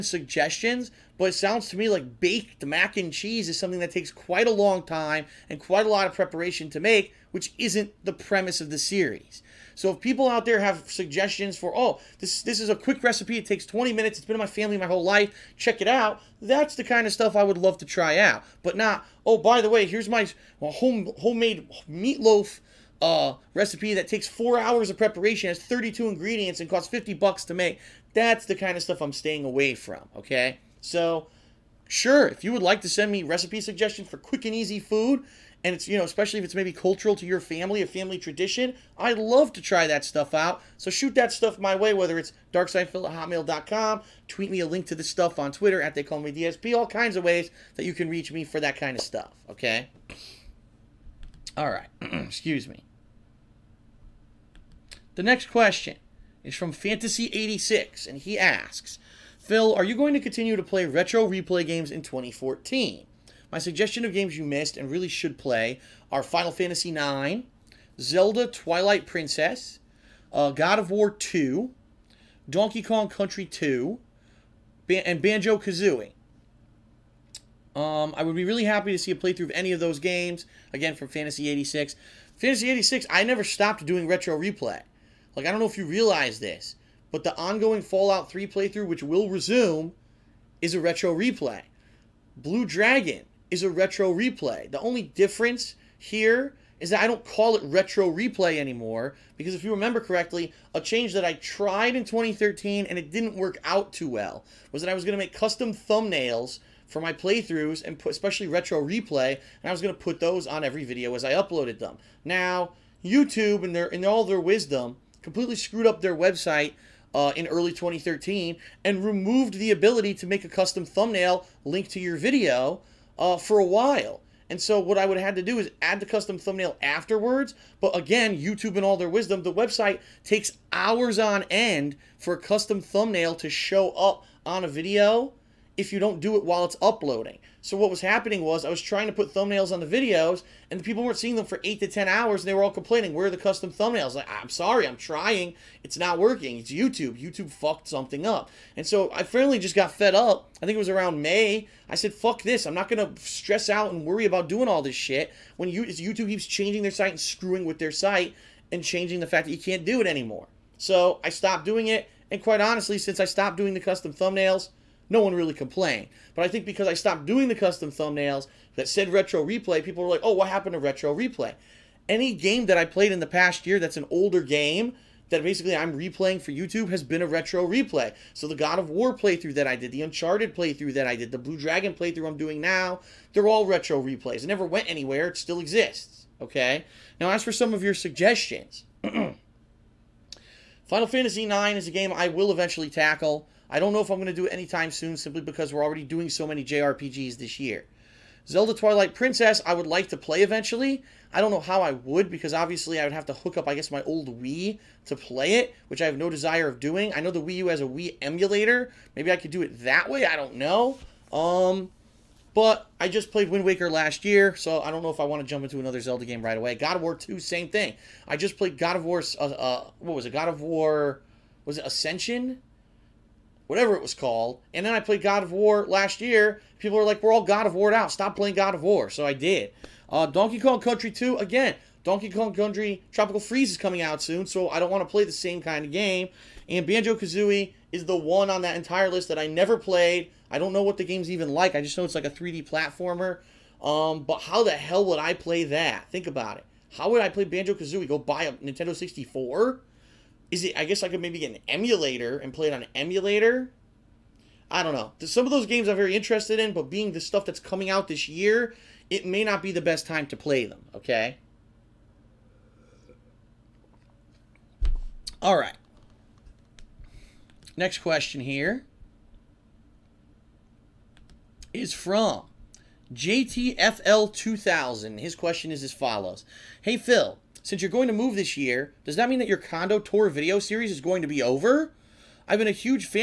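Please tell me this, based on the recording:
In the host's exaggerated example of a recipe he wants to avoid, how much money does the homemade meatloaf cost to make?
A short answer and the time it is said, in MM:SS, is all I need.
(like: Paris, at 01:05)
50 bucks, at 00:26.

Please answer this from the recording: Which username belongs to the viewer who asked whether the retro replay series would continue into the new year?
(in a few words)
Fantasy86.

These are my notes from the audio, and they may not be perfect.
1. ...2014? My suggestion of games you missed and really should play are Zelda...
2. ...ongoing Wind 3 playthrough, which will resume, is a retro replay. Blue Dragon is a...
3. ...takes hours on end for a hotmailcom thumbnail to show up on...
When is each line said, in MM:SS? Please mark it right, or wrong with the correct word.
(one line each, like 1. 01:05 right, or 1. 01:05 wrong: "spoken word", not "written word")
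1. 01:02 wrong: "Final", not "Zelda"
2. 01:27 wrong: "Fallout", not "Wind"
3. 02:10 wrong: "custom", not "hotmailcom".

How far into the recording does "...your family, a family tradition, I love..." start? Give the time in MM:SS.
00:37.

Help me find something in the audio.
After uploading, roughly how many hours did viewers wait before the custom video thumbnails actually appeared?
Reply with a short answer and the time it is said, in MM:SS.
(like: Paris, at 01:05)
8 to 10 hours, at 02:21.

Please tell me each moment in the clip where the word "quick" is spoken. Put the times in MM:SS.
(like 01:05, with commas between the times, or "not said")
00:12, 00:34.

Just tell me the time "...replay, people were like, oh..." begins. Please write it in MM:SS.
02:49.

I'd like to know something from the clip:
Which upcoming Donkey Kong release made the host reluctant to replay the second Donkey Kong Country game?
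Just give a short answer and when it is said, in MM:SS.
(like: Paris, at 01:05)
Tropical Freeze, at 03:53.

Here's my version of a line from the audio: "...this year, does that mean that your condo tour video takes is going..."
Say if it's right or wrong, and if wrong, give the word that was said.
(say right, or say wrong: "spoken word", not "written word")
wrong: "series", not "takes".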